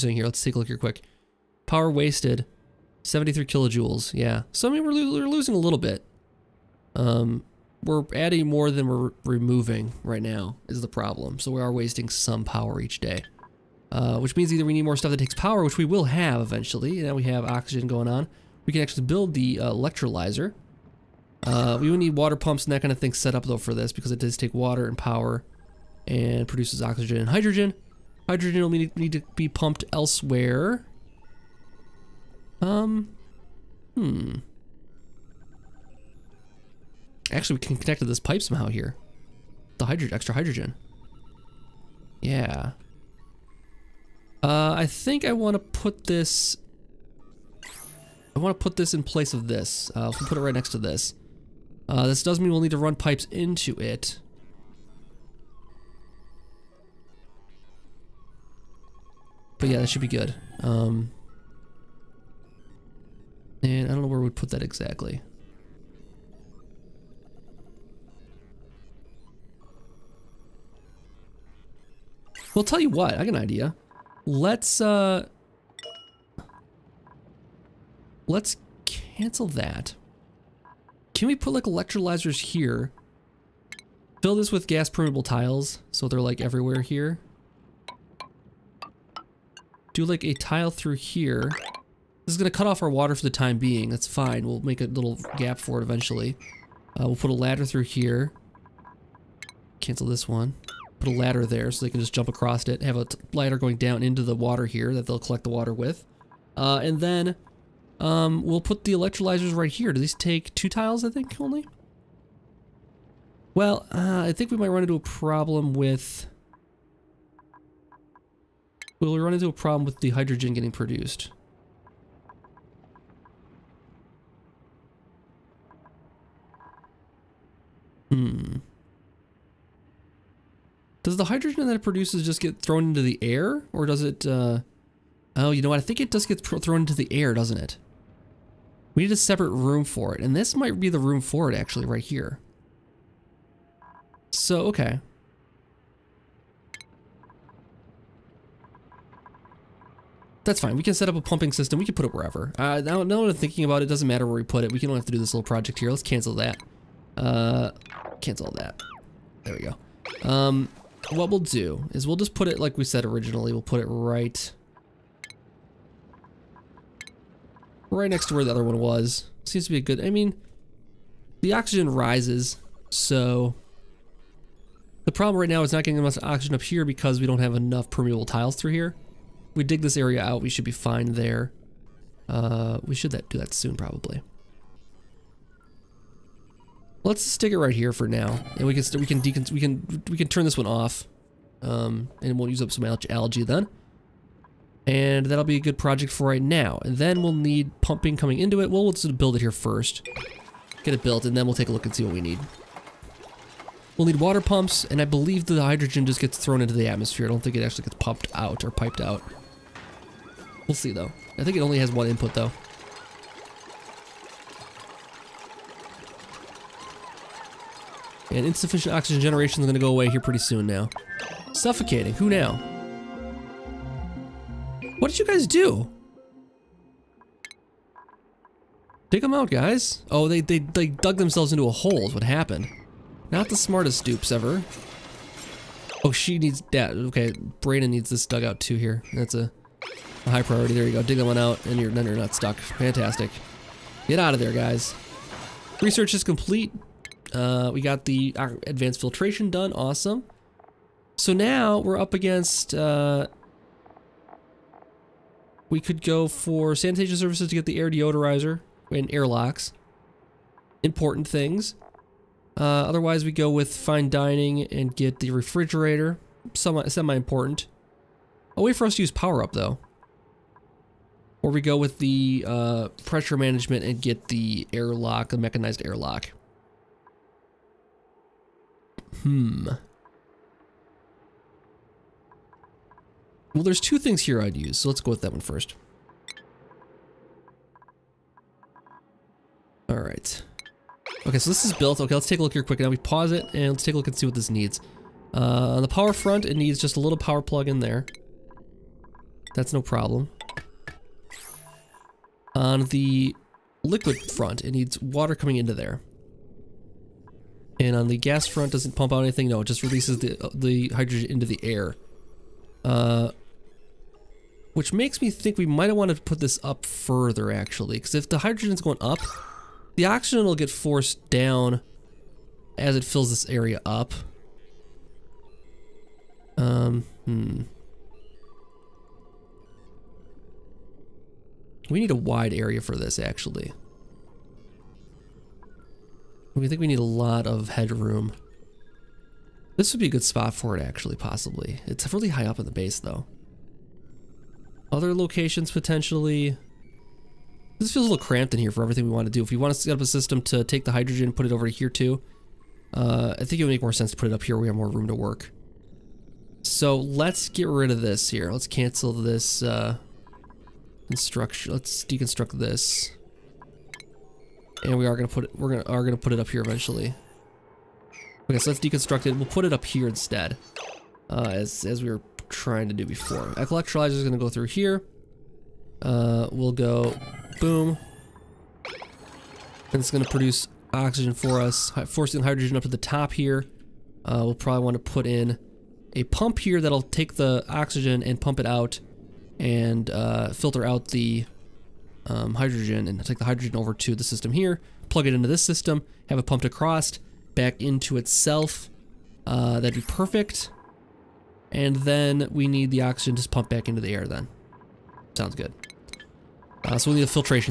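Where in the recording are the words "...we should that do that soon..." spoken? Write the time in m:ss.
3:02.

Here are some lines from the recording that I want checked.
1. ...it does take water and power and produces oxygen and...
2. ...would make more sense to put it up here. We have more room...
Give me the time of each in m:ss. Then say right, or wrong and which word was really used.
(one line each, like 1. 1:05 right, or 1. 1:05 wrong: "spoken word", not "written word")
1. 0:24 right
2. 5:53 right.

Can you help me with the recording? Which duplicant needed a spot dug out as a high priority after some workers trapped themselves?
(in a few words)
Brayden.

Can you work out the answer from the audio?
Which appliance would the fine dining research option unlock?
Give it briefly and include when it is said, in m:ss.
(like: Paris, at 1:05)
refrigerator, at 4:25.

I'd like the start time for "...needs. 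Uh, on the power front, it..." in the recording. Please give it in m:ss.
4:54.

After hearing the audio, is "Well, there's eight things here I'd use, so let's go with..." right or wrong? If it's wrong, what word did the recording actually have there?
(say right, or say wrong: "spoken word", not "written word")
wrong: "two", not "eight".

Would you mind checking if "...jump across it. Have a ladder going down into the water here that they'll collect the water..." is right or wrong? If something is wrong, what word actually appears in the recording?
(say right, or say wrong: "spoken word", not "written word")
right.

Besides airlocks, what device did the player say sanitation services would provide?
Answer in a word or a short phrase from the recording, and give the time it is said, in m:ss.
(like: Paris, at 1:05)
air deodorizer, at 4:17.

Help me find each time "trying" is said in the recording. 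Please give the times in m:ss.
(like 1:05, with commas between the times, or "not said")
6:12.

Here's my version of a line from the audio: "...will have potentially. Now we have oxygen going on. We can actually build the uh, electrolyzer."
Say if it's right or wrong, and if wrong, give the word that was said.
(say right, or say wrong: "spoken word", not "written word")
wrong: "eventually", not "potentially".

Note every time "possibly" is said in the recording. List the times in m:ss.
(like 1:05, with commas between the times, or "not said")
5:41.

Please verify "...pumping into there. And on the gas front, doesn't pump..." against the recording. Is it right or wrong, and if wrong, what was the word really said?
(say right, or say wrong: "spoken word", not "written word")
wrong: "coming", not "pumping".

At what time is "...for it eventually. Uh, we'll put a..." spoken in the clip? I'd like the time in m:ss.
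1:35.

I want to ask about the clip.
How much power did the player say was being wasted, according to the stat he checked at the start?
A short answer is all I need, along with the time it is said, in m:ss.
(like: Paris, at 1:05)
73 kilojoules, at 0:03.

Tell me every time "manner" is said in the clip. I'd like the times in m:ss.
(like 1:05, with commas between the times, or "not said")
not said.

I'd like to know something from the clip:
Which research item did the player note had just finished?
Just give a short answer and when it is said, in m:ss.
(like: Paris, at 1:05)
advanced filtration, at 4:08.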